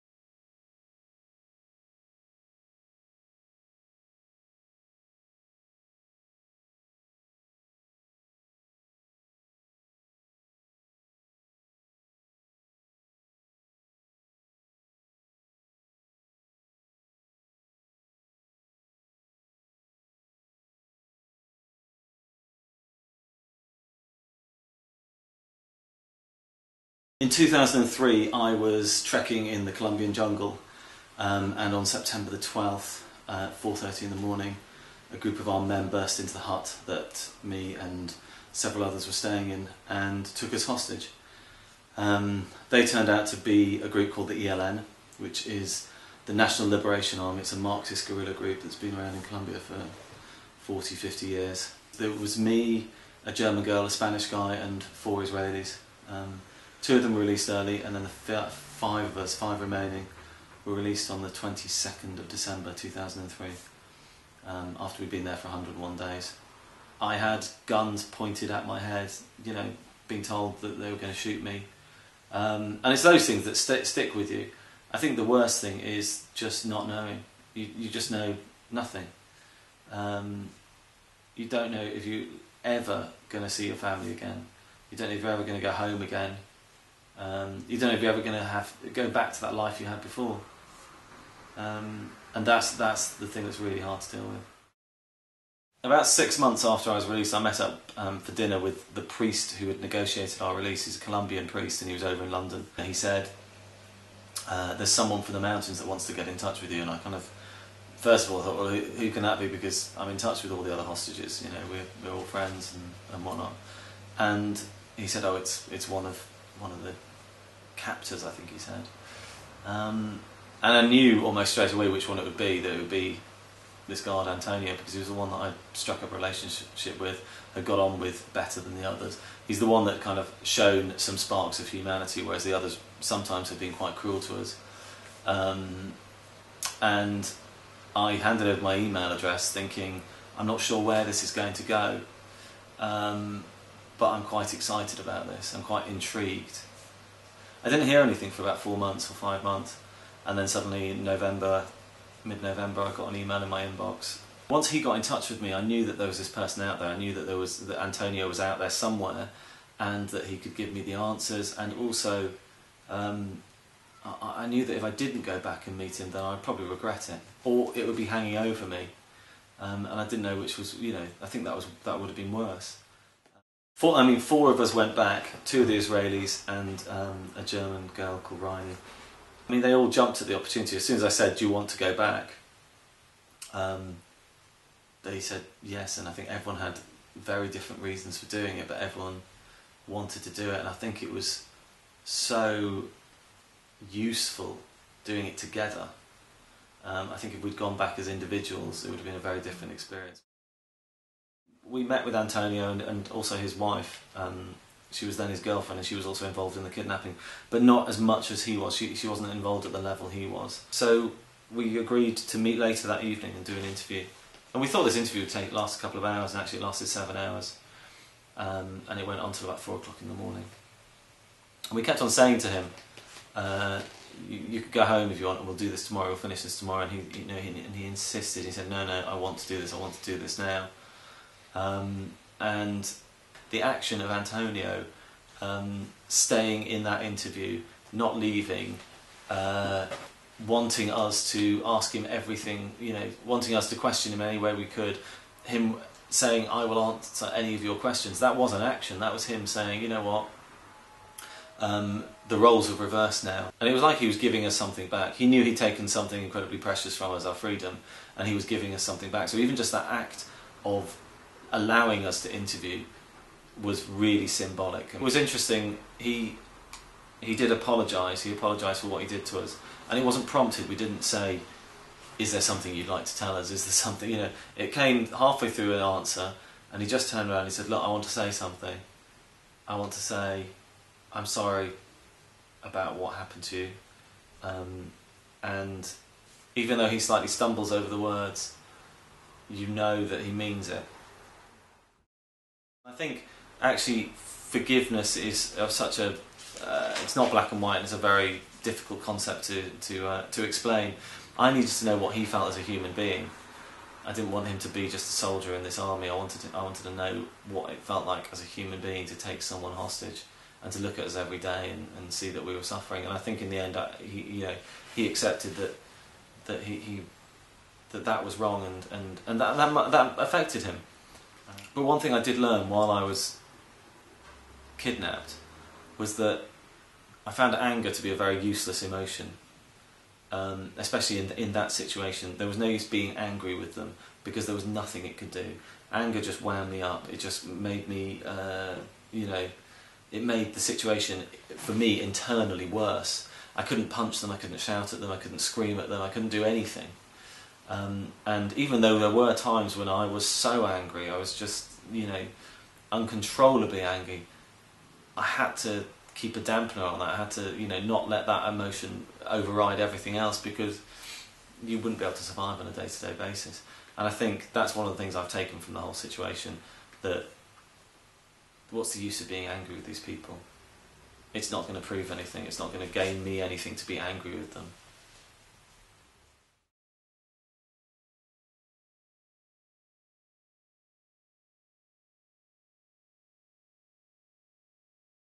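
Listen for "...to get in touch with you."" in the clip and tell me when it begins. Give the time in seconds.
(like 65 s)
106 s.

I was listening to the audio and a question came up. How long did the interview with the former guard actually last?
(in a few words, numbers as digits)
7 hours.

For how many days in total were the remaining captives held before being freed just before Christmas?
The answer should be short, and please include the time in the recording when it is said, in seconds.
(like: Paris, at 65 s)
101, at 65 s.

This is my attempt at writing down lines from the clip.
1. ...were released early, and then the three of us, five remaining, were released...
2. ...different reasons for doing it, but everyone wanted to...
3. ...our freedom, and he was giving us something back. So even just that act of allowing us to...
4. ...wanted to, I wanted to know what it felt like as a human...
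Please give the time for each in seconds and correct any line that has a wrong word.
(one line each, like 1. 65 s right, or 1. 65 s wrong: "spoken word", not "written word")
1. 57 s wrong: "five", not "three"
2. 187 s right
3. 257 s right
4. 306 s right.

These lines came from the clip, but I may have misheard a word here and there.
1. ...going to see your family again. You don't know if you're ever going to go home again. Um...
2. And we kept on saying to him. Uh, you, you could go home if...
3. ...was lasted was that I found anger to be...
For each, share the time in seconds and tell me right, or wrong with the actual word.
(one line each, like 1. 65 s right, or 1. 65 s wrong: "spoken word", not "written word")
1. 83 s right
2. 221 s right
3. 323 s wrong: "kidnapped", not "lasted".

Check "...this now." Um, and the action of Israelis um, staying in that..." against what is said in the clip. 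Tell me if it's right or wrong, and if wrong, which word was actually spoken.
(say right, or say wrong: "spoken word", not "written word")
wrong: "Antonio", not "Israelis".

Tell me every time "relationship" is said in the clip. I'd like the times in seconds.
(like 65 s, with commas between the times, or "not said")
126 s.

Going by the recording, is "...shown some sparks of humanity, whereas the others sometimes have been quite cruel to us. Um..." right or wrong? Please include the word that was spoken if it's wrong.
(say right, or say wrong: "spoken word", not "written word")
right.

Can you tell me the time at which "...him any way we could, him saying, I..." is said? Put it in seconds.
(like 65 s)
244 s.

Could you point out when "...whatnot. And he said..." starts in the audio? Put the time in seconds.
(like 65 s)
113 s.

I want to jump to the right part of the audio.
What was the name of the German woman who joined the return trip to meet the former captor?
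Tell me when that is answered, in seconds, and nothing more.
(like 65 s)
178 s.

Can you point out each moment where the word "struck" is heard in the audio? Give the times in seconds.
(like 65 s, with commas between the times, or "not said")
125 s.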